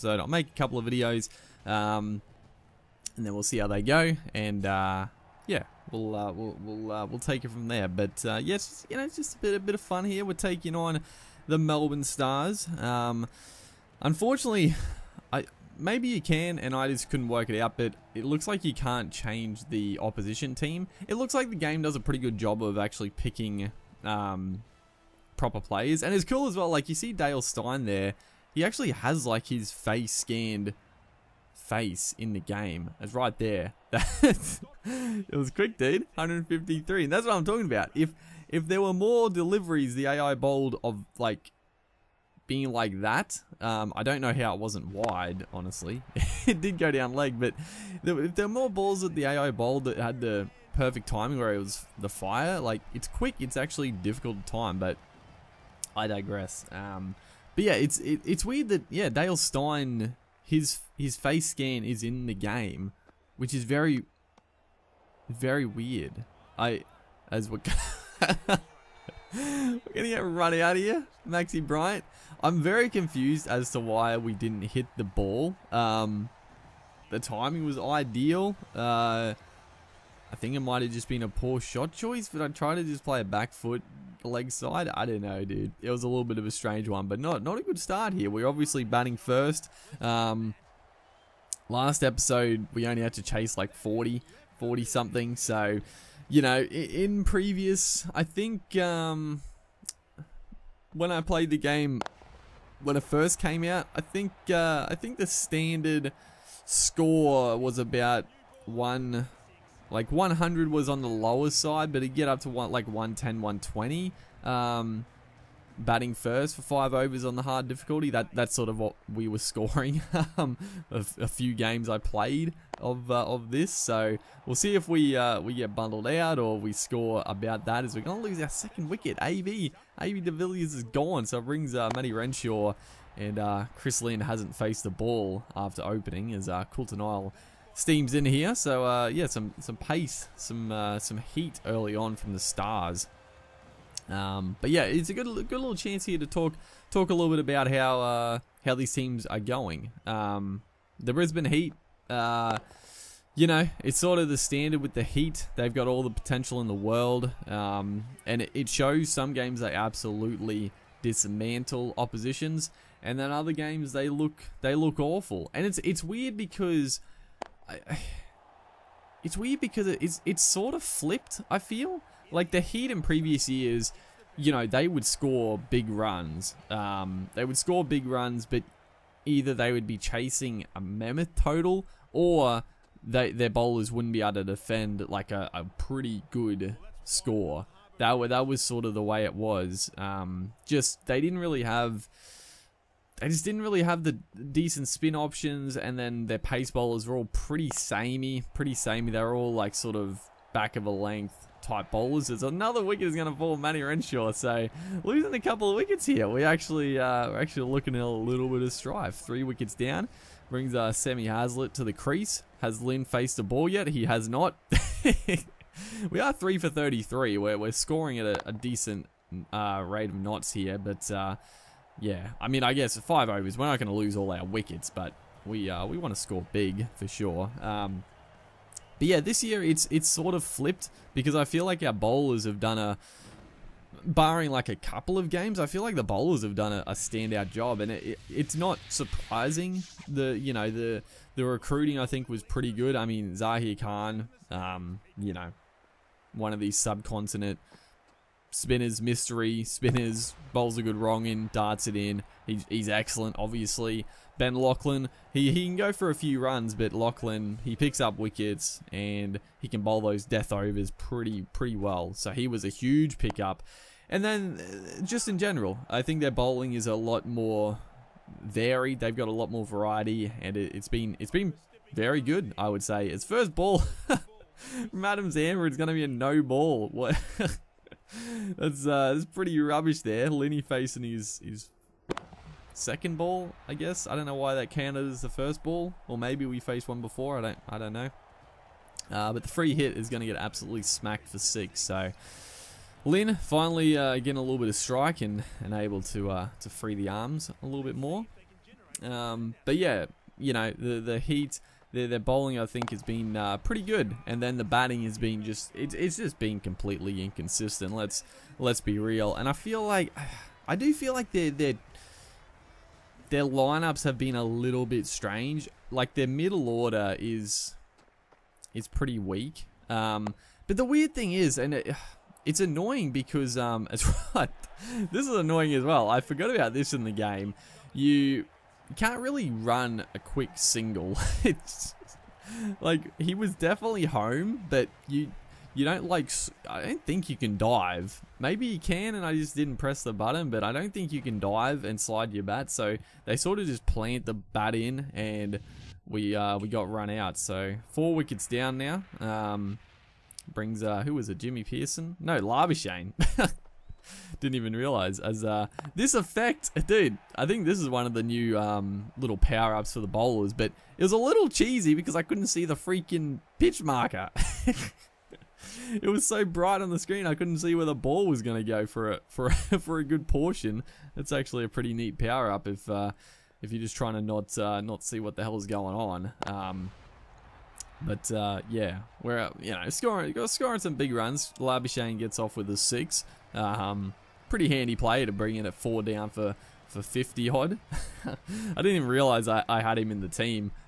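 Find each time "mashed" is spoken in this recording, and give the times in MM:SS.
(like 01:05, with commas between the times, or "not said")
not said.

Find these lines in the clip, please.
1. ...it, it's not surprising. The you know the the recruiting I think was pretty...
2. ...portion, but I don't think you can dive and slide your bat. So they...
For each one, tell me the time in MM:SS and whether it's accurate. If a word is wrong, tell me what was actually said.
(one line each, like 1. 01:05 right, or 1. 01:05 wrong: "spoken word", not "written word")
1. 03:58 right
2. 05:40 wrong: "button", not "portion".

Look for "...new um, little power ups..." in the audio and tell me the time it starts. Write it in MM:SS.
05:58.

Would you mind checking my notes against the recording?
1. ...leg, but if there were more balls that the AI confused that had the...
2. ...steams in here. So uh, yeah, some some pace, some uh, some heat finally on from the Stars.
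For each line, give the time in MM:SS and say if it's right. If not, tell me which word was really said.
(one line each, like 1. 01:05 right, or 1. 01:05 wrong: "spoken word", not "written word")
1. 00:47 wrong: "bowled", not "confused"
2. 02:17 wrong: "early", not "finally".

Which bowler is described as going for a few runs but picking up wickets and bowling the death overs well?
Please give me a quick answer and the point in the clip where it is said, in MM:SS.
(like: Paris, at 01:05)
Ben Laughlin, at 04:14.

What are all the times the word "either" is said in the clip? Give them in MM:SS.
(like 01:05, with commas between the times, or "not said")
02:59.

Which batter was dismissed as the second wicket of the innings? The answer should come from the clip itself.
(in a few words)
AB de Villiers.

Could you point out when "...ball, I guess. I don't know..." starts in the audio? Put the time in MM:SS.
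04:43.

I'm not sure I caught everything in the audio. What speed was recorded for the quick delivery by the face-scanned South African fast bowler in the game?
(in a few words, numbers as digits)
153.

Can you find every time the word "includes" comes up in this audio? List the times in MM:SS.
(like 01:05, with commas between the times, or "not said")
not said.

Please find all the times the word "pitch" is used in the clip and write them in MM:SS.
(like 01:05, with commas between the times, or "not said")
06:03.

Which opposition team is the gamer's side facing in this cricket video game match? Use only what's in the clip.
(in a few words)
Melbourne Stars.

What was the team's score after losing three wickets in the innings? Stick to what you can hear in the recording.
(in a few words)
3 for 33.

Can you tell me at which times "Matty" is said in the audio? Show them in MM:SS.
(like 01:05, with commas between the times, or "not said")
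02:11, 03:23.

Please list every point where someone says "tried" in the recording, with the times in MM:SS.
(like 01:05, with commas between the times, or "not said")
01:22.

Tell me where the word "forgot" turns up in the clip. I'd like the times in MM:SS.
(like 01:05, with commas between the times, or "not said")
05:26.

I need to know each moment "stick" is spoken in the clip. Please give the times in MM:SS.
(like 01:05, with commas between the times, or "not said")
not said.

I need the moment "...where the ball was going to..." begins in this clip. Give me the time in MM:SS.
06:07.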